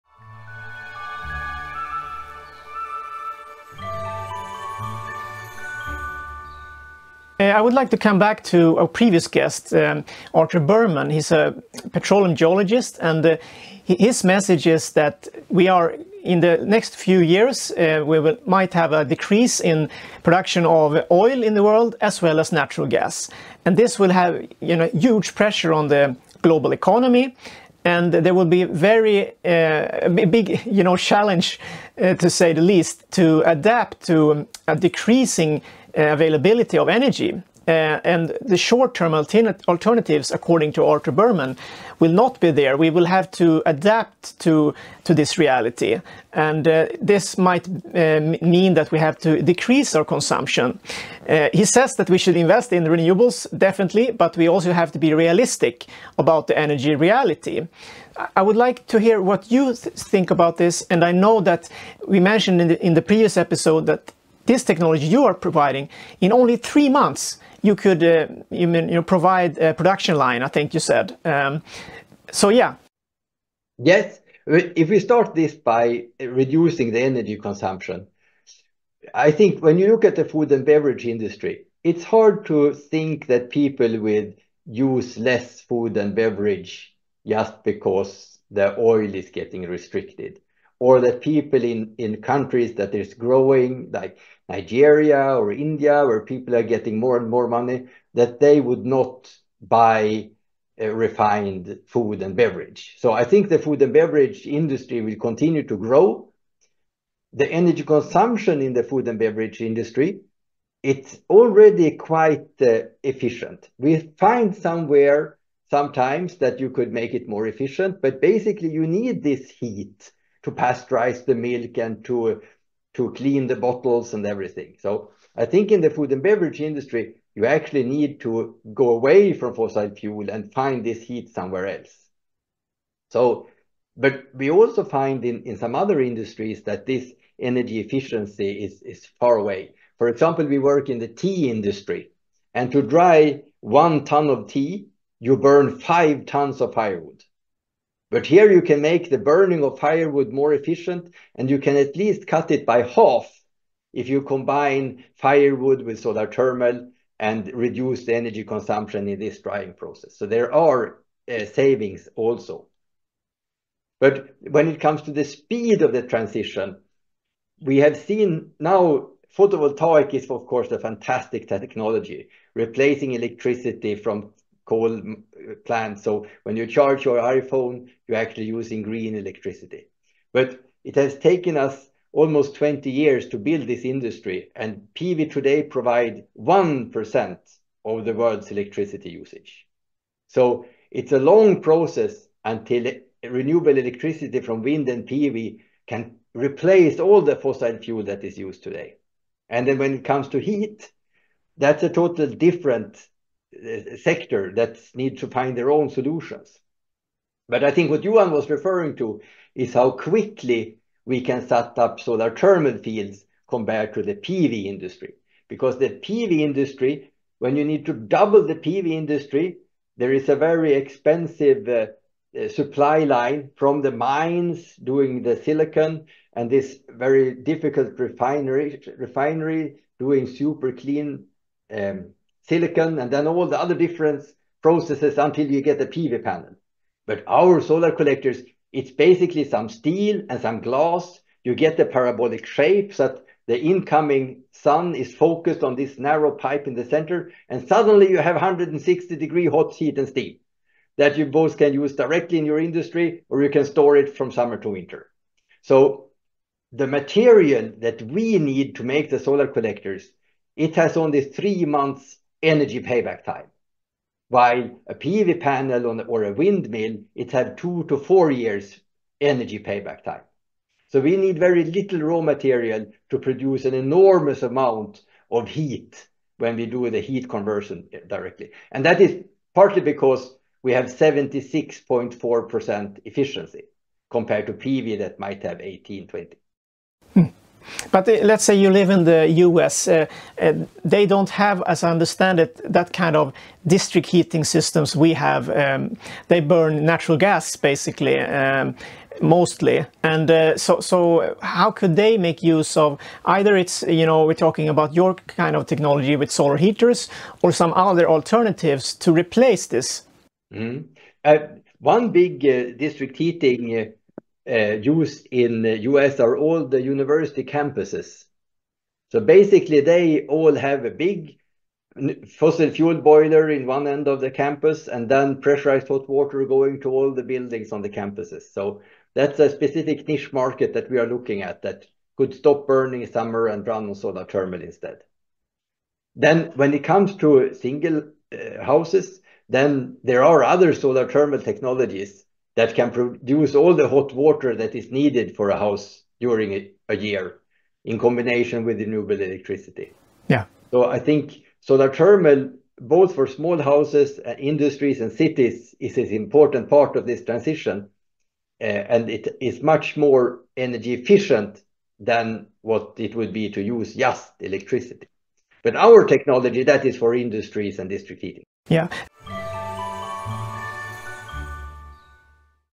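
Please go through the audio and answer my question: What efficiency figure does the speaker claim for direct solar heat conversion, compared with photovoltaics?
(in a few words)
76.4%.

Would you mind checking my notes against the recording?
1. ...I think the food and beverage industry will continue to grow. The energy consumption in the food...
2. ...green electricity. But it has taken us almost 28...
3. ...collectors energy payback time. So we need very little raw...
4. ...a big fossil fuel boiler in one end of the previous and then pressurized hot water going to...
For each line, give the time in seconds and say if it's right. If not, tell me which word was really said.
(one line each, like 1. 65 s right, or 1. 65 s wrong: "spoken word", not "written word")
1. 103 s right
2. 178 s wrong: "20", not "28"
3. 268 s wrong: "years", not "collectors"
4. 320 s wrong: "campus", not "previous".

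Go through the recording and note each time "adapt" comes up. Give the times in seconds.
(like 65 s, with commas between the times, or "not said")
33 s, 43 s.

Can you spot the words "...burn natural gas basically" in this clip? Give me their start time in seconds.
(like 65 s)
296 s.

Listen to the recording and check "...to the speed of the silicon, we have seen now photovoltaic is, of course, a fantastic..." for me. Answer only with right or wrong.
wrong.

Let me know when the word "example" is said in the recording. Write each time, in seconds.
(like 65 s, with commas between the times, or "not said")
140 s.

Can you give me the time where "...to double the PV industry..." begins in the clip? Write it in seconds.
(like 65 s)
217 s.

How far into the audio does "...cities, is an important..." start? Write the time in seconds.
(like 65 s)
355 s.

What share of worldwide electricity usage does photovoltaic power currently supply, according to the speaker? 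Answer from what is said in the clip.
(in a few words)
1%.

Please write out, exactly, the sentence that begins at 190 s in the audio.
So it's a long process until renewable electricity from wind and PV can replace all the fossil fuel that is used today.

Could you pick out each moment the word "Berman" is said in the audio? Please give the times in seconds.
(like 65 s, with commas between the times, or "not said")
10 s, 41 s.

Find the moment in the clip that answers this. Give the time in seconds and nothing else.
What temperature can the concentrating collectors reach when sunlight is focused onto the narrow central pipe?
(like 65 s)
248 s.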